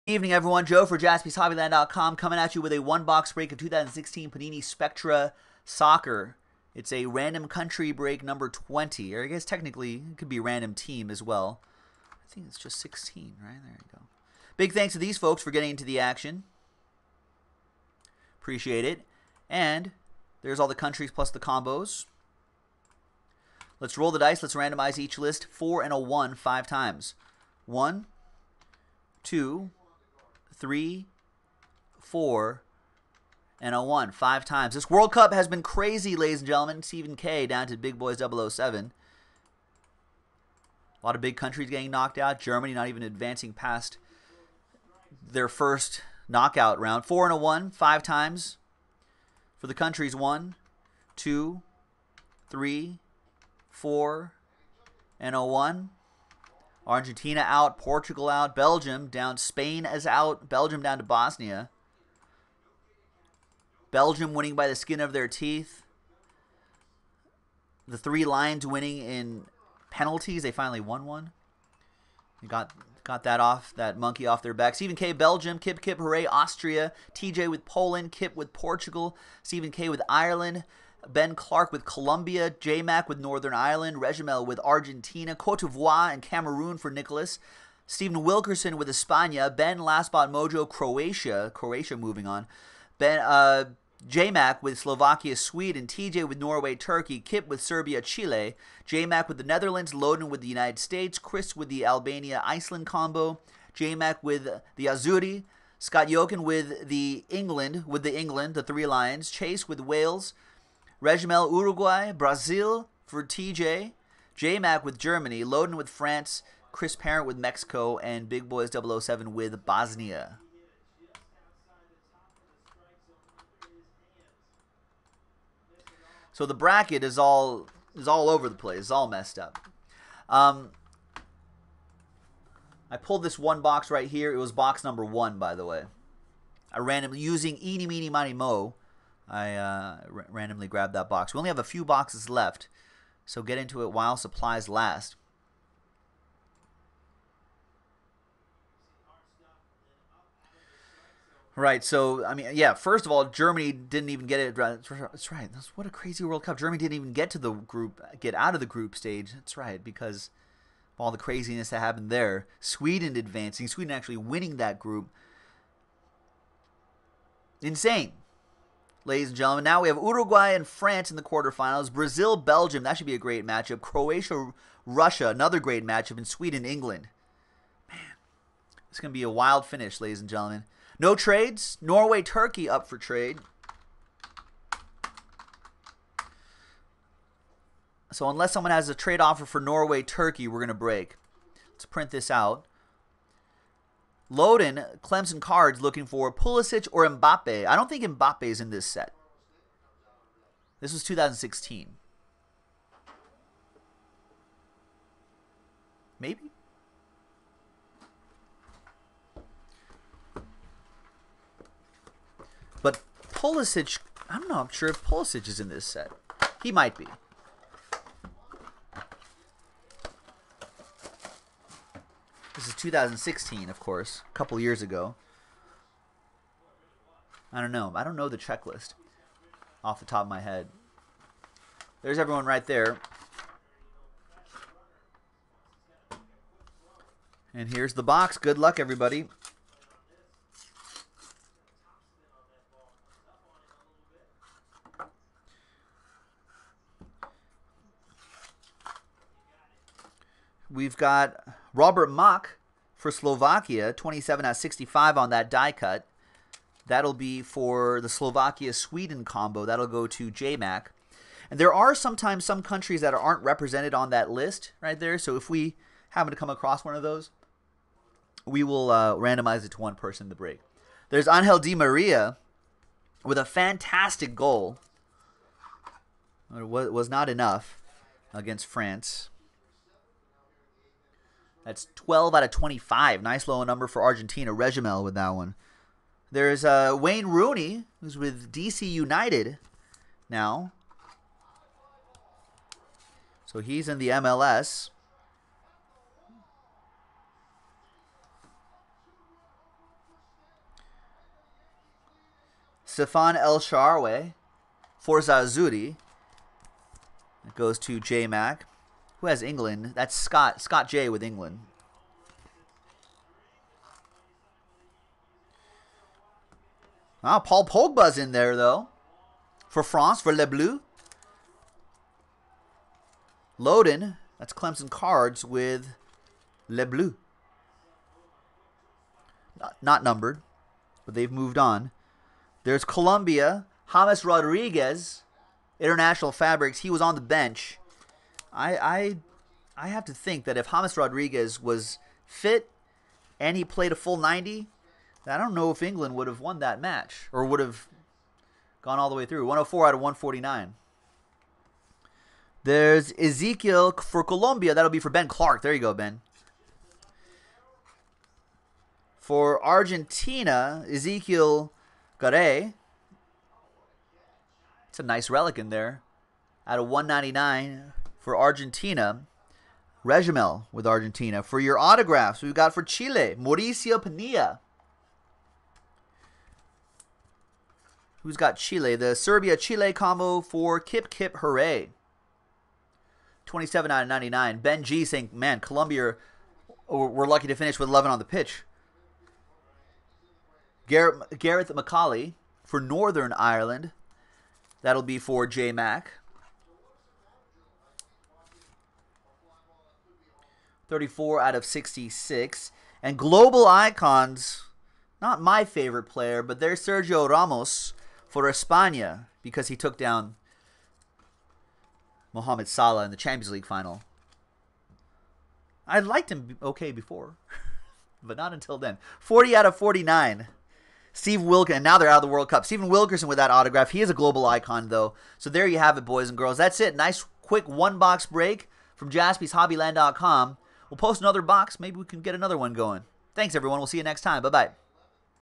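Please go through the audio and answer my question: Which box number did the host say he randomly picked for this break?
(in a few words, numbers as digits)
1.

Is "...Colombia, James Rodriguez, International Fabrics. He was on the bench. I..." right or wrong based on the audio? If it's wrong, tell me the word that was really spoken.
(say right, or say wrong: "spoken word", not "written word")
right.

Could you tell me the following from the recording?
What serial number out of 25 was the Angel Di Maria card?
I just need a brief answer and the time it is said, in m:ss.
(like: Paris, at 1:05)
12, at 4:41.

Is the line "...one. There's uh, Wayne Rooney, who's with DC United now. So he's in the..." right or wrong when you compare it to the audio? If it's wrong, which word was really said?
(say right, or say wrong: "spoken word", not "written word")
right.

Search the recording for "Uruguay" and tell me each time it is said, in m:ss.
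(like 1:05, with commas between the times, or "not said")
1:51, 2:49.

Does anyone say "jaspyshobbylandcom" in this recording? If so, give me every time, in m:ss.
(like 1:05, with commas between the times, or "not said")
0:00, 7:09.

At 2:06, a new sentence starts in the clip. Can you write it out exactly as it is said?
So the bracket is all is all over the place.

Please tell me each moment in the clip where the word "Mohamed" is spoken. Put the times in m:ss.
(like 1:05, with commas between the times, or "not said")
6:52.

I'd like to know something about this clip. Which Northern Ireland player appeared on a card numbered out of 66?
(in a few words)
Gareth McAuley.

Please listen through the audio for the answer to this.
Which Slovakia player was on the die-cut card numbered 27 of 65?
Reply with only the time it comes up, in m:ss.
4:11.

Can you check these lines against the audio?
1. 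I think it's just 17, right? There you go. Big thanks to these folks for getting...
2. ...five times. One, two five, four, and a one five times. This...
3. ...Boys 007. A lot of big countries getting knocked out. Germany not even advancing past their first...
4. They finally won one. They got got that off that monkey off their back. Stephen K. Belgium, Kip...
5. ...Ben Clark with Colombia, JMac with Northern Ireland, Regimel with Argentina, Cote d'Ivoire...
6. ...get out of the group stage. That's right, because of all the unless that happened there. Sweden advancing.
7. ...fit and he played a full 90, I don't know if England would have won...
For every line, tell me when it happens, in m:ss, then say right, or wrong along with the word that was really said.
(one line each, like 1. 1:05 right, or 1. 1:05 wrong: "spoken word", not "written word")
1. 0:12 wrong: "16", not "17"
2. 0:26 wrong: "three", not "five"
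3. 0:37 right
4. 1:10 right
5. 1:21 right
6. 2:38 wrong: "craziness", not "unless"
7. 5:42 right.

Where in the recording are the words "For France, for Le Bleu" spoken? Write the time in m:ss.
5:19.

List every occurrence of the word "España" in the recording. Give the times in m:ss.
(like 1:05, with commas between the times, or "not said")
1:28, 6:48.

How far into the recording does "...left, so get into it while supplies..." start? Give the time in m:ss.
2:22.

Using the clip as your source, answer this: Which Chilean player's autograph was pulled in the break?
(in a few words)
Mauricio Pinilla.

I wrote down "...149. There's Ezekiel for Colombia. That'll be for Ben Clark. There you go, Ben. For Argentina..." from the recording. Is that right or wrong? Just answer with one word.
right.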